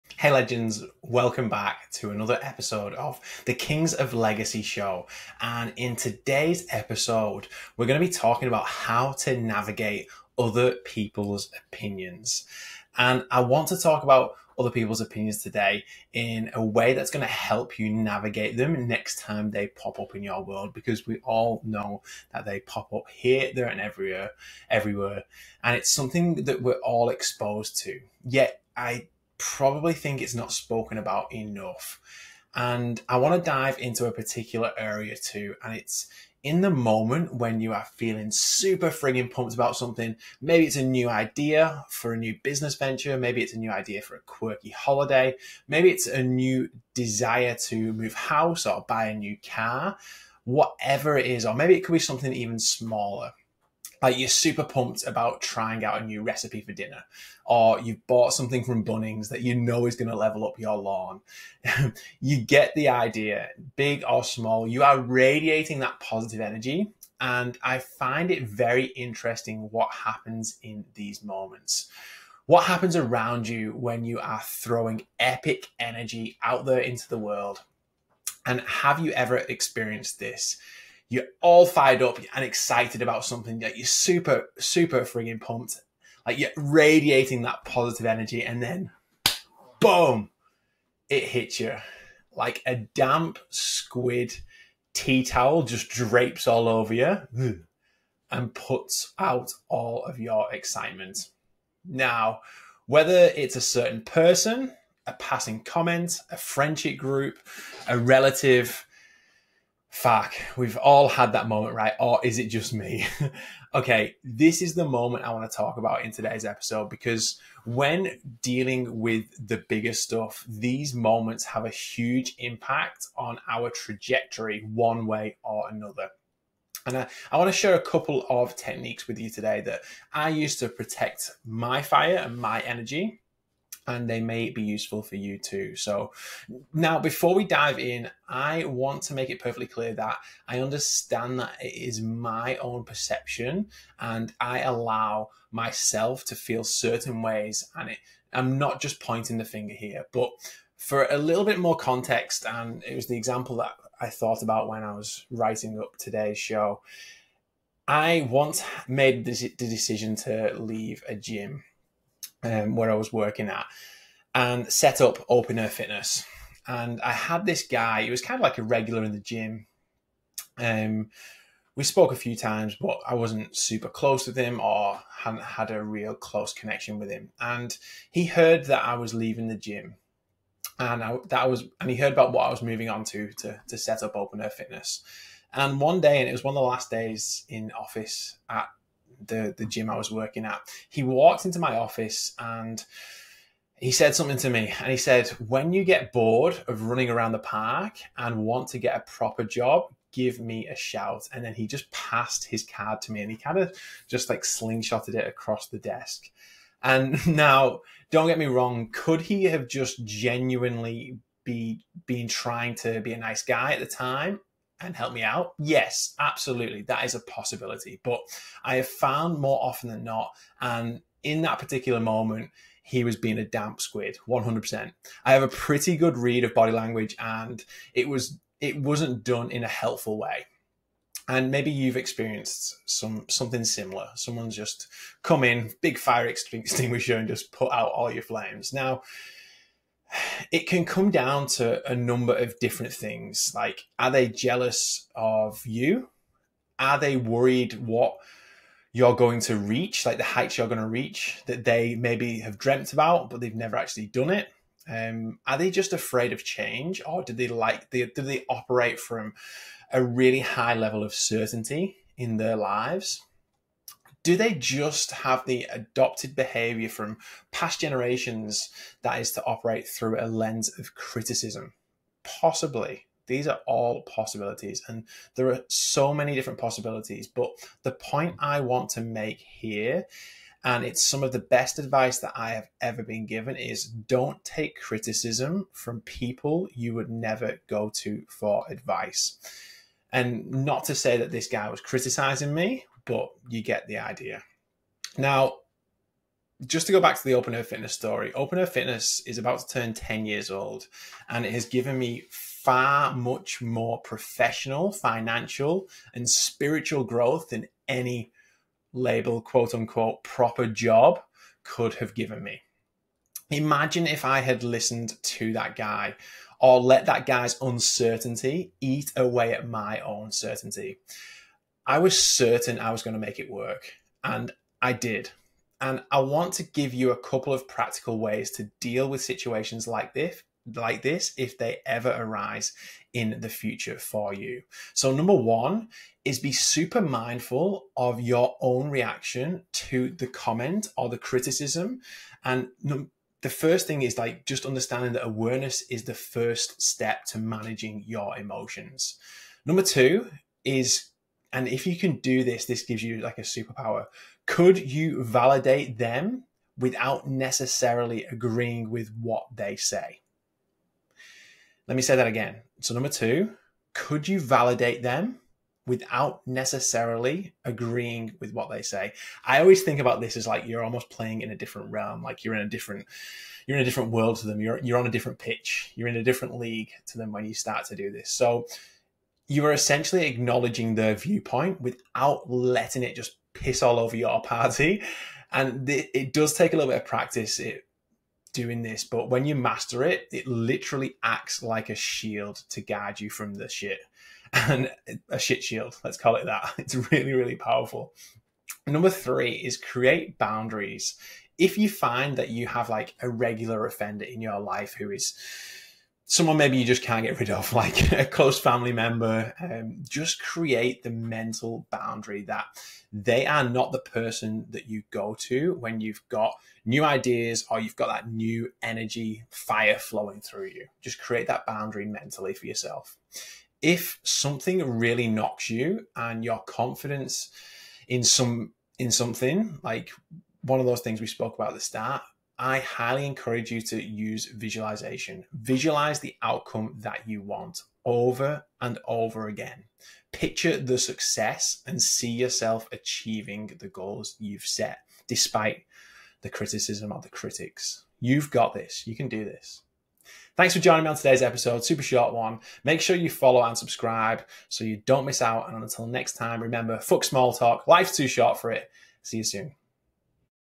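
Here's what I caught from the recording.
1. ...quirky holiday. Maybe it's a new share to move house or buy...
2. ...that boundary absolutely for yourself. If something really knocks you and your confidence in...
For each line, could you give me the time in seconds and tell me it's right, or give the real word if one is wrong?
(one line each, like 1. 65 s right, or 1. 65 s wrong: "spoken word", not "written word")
1. 44 s wrong: "desire", not "share"
2. 421 s wrong: "mentally", not "absolutely".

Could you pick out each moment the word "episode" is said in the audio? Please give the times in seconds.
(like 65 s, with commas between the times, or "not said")
2 s, 6 s, 116 s, 451 s.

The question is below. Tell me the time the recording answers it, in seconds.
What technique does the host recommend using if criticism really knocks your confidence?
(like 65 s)
434 s.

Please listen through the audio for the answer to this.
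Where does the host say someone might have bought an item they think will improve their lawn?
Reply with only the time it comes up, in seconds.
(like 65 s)
58 s.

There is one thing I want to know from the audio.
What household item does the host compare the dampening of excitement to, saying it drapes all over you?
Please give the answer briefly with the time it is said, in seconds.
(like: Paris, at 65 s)
Damp squid tea towel, at 92 s.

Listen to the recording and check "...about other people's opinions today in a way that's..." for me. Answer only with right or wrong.
right.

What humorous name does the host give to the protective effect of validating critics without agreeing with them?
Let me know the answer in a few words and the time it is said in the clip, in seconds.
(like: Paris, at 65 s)
Shit shield, at 395 s.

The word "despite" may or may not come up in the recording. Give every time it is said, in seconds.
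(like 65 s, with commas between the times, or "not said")
445 s.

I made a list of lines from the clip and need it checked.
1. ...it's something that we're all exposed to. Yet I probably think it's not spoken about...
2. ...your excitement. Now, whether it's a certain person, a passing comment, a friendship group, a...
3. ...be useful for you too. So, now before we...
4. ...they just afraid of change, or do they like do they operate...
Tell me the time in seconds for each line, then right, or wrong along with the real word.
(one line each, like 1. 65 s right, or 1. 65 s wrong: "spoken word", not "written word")
1. 25 s right
2. 100 s right
3. 134 s right
4. 255 s right.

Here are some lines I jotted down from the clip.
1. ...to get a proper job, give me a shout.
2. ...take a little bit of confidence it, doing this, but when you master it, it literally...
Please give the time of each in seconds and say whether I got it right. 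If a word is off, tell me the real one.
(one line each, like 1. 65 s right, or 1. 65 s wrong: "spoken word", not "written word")
1. 198 s right
2. 386 s wrong: "practice", not "confidence".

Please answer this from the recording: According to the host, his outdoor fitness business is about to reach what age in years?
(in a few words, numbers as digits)
10.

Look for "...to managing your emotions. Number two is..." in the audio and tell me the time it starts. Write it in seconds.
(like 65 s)
347 s.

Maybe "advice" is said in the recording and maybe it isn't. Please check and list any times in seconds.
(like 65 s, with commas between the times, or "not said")
281 s, 288 s.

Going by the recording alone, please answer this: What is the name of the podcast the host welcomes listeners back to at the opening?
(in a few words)
Kings of Legacy.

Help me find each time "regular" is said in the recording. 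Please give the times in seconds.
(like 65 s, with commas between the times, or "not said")
168 s, 403 s.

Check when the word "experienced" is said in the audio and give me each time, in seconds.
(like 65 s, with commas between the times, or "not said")
79 s, 231 s.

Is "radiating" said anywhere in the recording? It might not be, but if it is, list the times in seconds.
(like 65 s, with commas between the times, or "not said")
64 s, 86 s.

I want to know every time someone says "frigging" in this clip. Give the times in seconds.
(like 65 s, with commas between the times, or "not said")
38 s, 85 s.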